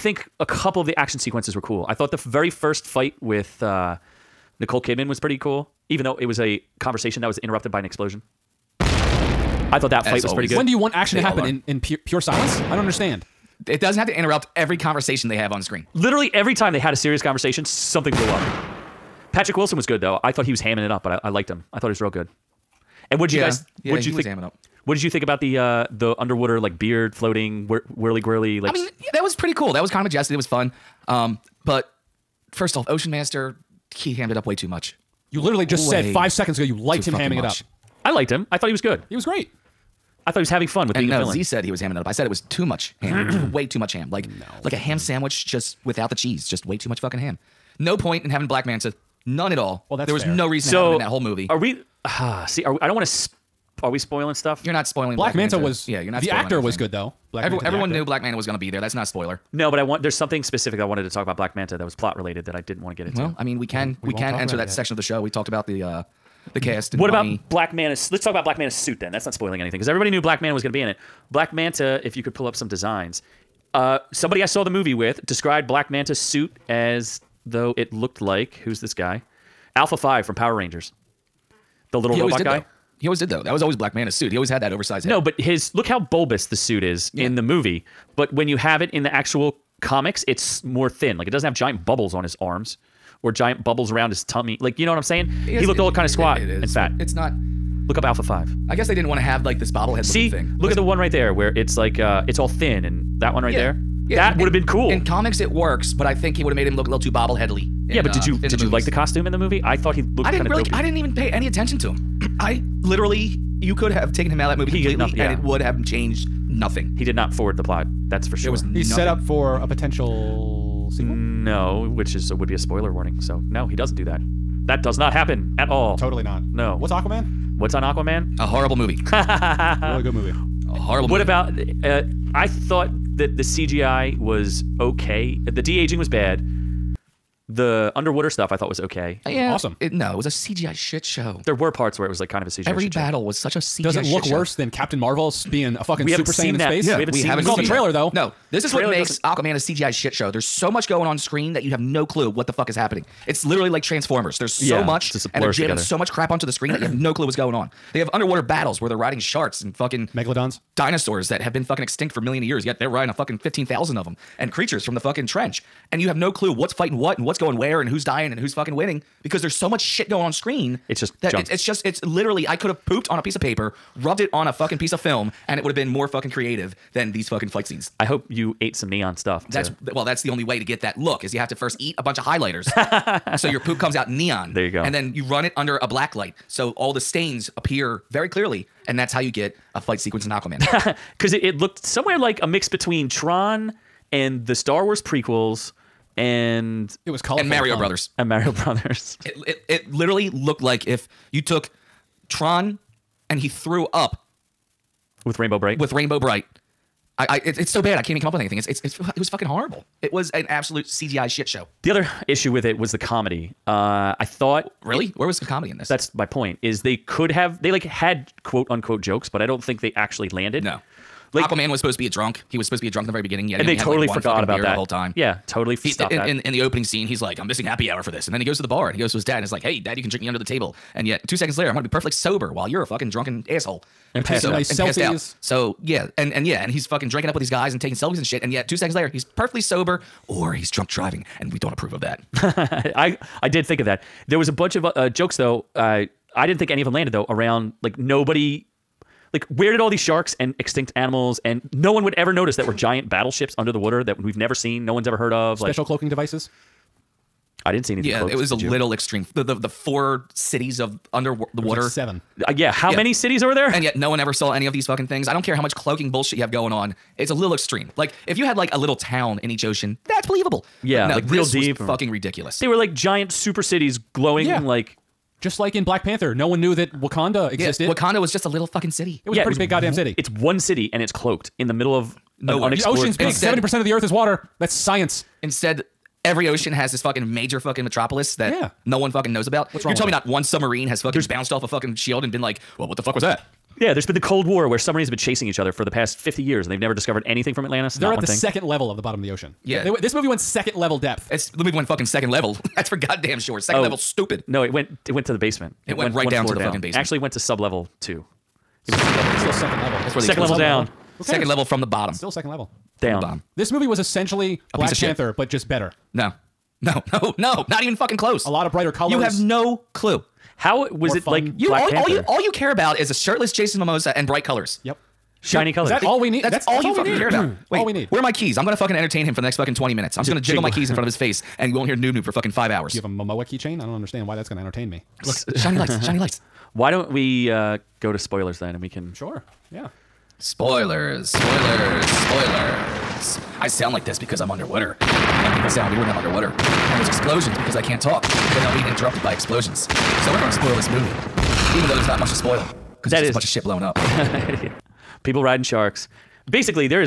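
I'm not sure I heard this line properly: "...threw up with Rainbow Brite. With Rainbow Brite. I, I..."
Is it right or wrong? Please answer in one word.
right.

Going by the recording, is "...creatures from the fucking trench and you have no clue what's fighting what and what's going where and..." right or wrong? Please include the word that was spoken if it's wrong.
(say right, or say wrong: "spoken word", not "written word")
right.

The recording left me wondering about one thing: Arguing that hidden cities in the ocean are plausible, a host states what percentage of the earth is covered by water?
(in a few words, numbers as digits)
70 percent.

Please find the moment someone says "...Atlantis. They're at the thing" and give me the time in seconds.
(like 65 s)
297 s.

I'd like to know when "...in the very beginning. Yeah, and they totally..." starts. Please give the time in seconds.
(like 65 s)
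223 s.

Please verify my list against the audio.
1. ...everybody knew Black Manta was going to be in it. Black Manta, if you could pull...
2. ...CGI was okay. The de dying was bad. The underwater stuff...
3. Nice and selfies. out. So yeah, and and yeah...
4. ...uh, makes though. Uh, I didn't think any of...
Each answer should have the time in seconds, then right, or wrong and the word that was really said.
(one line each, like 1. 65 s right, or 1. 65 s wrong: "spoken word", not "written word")
1. 69 s right
2. 133 s wrong: "aging", not "dying"
3. 234 s right
4. 244 s wrong: "jokes", not "makes".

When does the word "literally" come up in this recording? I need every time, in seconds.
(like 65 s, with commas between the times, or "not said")
15 s, 35 s, 112 s, 153 s, 172 s, 199 s.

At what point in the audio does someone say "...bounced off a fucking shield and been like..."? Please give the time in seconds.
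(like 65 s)
291 s.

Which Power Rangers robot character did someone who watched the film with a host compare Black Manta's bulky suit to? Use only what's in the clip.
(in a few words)
Alpha 5.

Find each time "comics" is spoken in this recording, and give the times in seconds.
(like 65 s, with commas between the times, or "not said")
89 s, 105 s.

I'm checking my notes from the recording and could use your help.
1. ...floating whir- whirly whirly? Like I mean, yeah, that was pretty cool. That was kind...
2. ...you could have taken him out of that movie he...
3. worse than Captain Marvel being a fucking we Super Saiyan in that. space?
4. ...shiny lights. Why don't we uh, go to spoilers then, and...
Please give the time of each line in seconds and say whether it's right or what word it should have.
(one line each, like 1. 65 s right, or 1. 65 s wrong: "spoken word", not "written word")
1. 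27 s right
2. 113 s right
3. 144 s right
4. 336 s right.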